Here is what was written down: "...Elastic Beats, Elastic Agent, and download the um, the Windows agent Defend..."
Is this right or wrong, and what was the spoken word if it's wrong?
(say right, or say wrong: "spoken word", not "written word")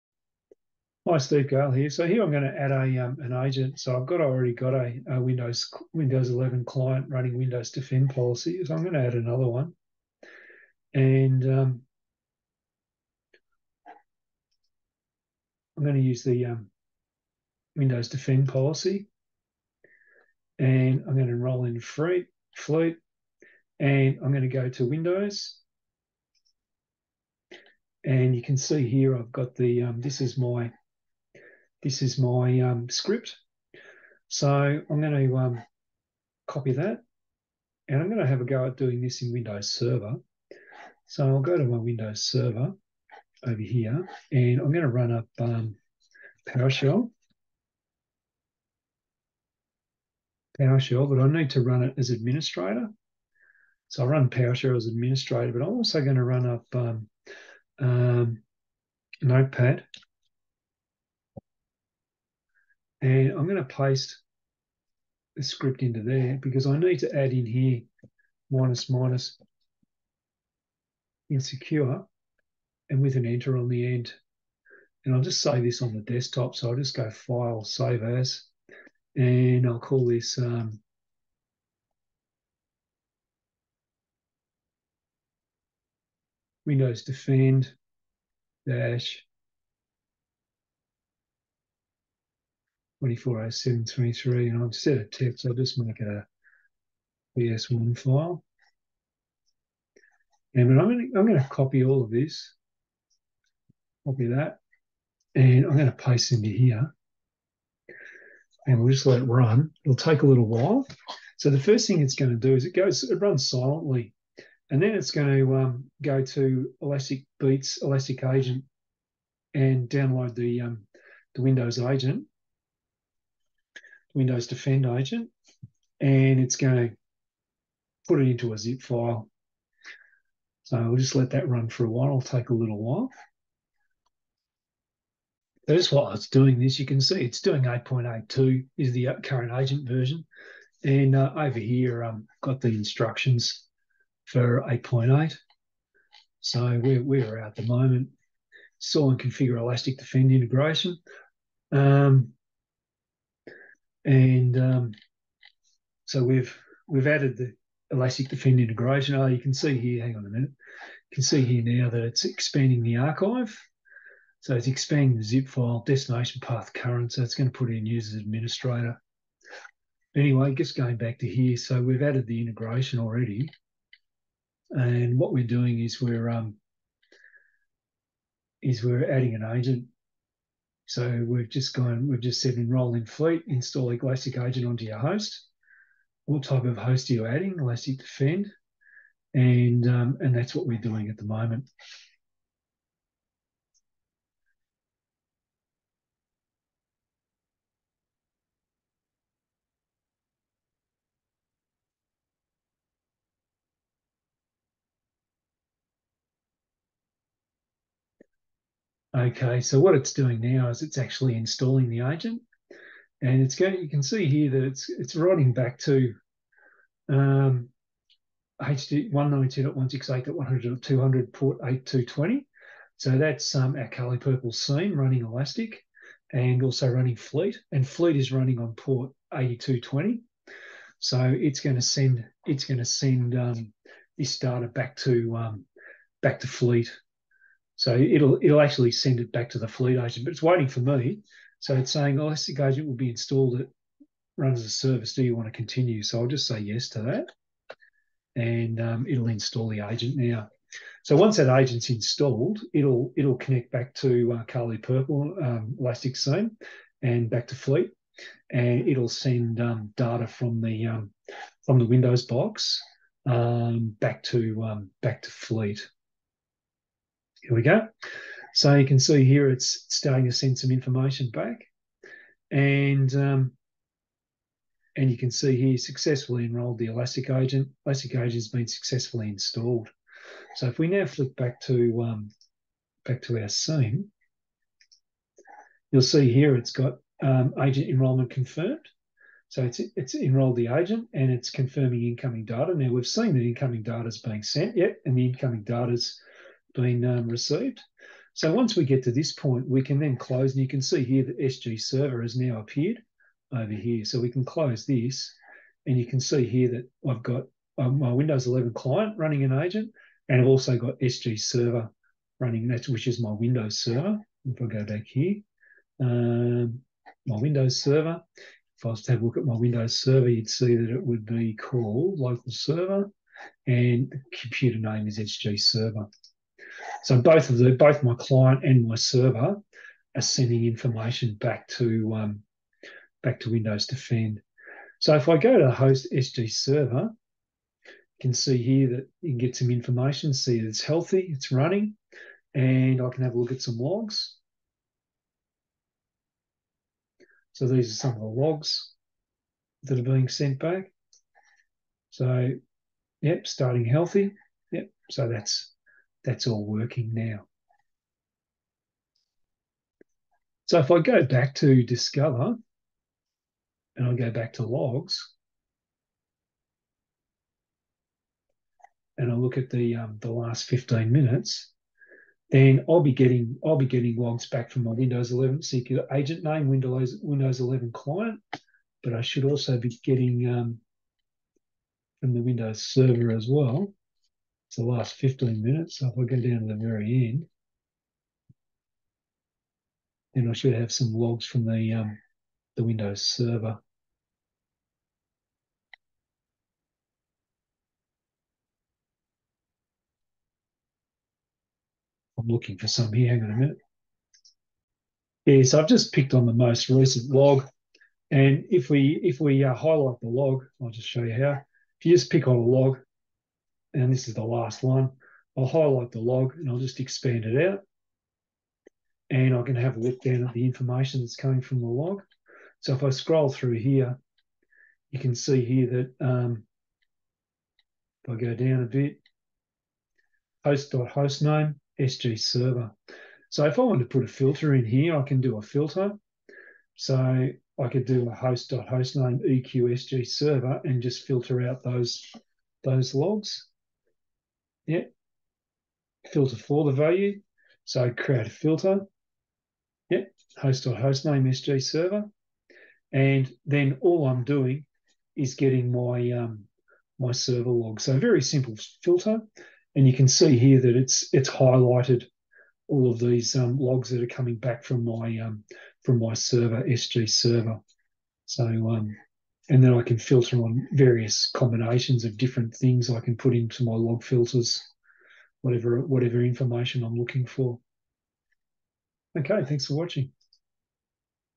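wrong: "Windows", not "Defend".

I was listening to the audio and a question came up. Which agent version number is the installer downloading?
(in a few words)
8.82.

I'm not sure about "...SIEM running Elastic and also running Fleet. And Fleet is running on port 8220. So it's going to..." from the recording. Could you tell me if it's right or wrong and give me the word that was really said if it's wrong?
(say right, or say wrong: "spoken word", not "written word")
right.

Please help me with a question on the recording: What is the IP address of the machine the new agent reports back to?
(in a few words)
192.168.100.200.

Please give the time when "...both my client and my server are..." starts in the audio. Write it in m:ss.
5:27.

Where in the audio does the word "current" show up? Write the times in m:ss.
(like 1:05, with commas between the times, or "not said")
2:19, 2:46.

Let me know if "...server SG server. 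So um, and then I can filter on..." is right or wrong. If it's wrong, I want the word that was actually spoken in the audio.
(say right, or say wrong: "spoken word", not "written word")
right.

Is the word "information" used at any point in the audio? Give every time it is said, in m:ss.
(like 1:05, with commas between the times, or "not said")
4:30, 5:30, 5:39, 7:00, 7:56.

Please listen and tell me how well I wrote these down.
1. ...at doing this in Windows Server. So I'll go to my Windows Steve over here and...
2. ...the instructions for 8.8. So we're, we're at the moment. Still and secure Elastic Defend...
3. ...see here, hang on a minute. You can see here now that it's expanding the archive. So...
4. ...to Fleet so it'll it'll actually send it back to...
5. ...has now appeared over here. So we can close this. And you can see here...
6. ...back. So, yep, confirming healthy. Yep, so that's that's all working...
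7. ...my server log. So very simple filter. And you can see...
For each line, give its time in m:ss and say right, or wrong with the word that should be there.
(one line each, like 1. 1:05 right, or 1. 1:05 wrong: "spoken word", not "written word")
1. 0:38 wrong: "Server", not "Steve"
2. 2:22 wrong: "configure", not "secure"
3. 2:39 right
4. 3:56 right
5. 5:02 right
6. 5:50 wrong: "starting", not "confirming"
7. 7:37 right.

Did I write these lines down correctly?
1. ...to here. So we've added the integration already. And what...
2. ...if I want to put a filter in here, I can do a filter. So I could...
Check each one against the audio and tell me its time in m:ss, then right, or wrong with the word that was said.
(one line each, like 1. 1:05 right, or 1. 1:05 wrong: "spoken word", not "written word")
1. 2:51 right
2. 7:13 right.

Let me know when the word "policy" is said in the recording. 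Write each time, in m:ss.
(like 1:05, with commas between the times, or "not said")
0:08, 0:18.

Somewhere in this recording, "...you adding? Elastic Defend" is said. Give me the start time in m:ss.
3:07.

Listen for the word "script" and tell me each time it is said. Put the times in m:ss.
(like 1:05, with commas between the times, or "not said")
0:32, 1:05.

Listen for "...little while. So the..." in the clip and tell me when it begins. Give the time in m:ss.
1:50.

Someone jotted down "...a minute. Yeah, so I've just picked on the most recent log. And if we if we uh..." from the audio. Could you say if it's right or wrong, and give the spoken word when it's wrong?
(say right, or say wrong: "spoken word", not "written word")
right.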